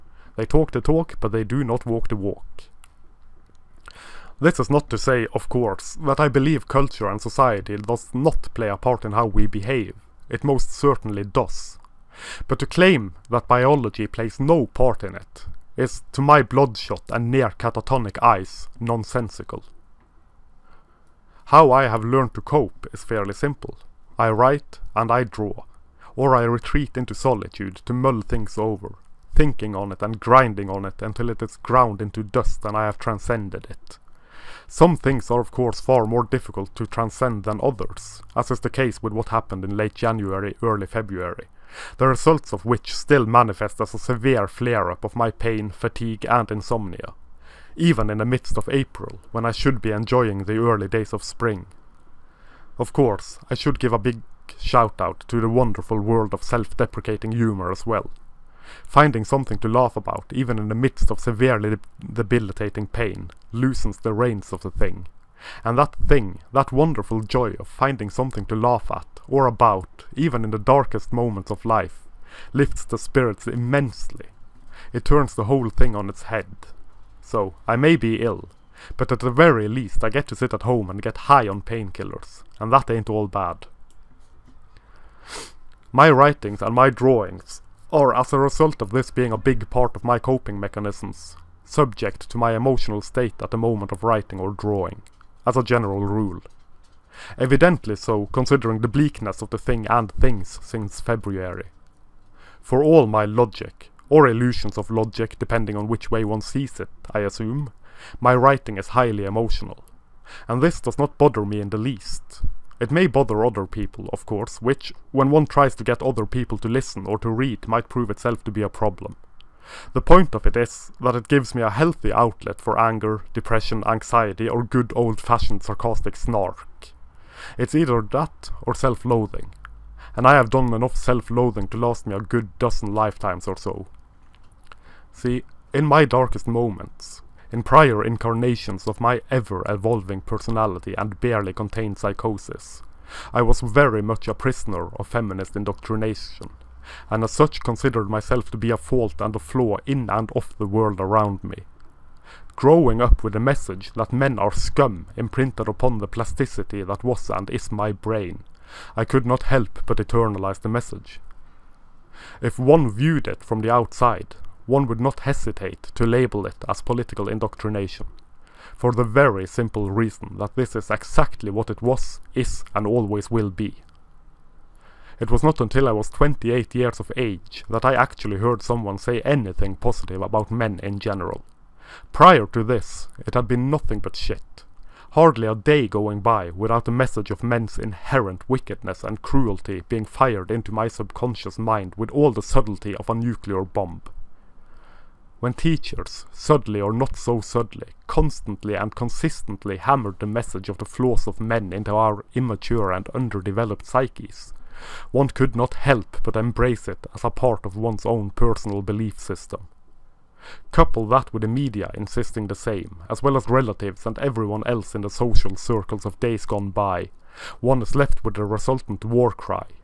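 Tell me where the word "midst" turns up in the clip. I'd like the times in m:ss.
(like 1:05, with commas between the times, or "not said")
0:48, 1:00.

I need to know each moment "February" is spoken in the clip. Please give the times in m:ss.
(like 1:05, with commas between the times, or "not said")
0:40, 1:41.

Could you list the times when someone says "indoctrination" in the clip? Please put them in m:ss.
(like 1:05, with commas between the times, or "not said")
2:25, 2:47.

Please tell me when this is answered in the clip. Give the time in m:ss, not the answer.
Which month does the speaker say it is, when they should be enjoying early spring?
0:48.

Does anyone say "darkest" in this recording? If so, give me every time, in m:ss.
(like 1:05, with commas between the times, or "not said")
1:10, 2:16.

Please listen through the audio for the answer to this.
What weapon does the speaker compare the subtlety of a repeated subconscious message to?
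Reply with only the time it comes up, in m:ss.
3:13.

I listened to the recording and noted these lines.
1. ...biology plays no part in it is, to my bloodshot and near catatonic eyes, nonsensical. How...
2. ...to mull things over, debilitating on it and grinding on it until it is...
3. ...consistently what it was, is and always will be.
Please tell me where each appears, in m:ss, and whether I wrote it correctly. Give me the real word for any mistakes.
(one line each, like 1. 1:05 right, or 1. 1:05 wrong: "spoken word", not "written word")
1. 0:13 right
2. 0:27 wrong: "thinking", not "debilitating"
3. 2:50 wrong: "exactly", not "consistently".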